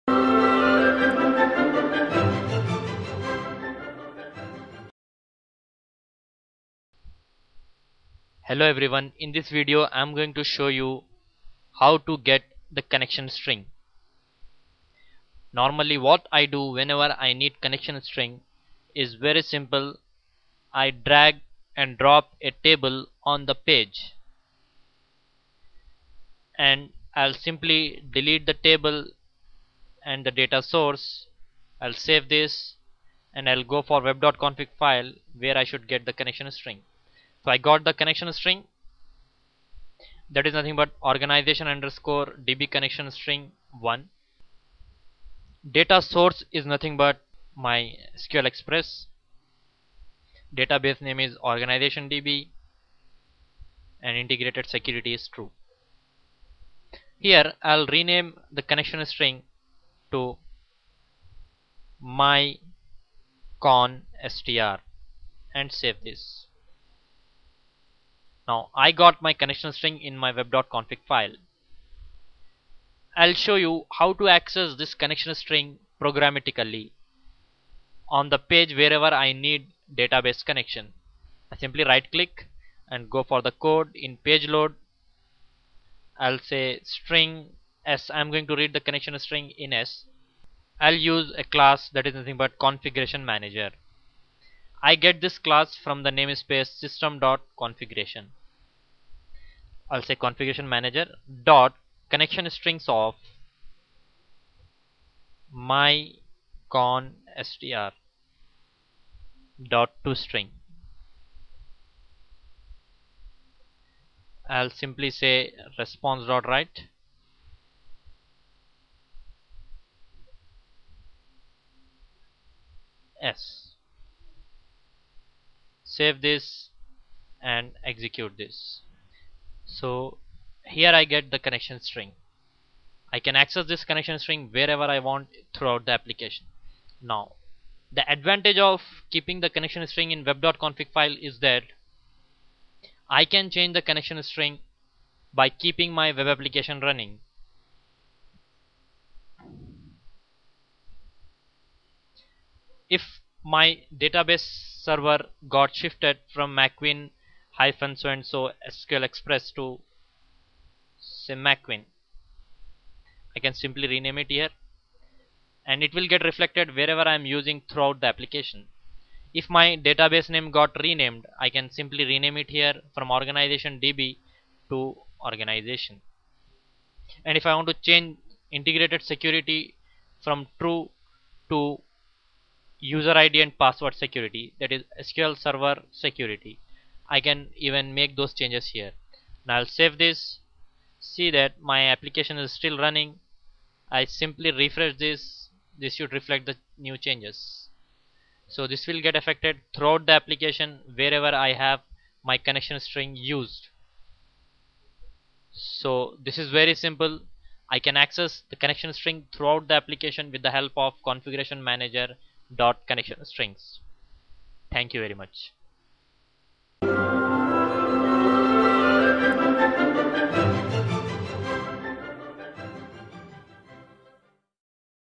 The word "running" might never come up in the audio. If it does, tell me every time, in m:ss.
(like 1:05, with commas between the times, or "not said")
2:26, 3:12.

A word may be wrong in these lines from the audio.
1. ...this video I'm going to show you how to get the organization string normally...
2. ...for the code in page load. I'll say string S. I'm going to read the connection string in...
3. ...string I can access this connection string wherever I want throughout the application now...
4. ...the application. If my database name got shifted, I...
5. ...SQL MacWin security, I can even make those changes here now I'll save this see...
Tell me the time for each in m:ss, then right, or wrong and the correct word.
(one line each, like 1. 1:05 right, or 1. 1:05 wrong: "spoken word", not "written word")
1. 0:09 wrong: "connection", not "organization"
2. 1:23 right
3. 2:11 right
4. 2:48 wrong: "renamed", not "shifted"
5. 3:05 wrong: "Server", not "MacWin".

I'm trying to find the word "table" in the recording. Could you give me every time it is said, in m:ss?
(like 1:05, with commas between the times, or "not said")
0:22, 0:28.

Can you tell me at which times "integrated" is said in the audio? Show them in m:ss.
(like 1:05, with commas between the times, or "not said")
0:54, 2:58.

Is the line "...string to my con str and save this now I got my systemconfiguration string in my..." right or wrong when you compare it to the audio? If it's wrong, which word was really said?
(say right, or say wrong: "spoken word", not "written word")
wrong: "connection", not "systemconfiguration".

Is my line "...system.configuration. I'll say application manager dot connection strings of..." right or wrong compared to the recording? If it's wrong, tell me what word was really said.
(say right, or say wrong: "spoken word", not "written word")
wrong: "configuration", not "application".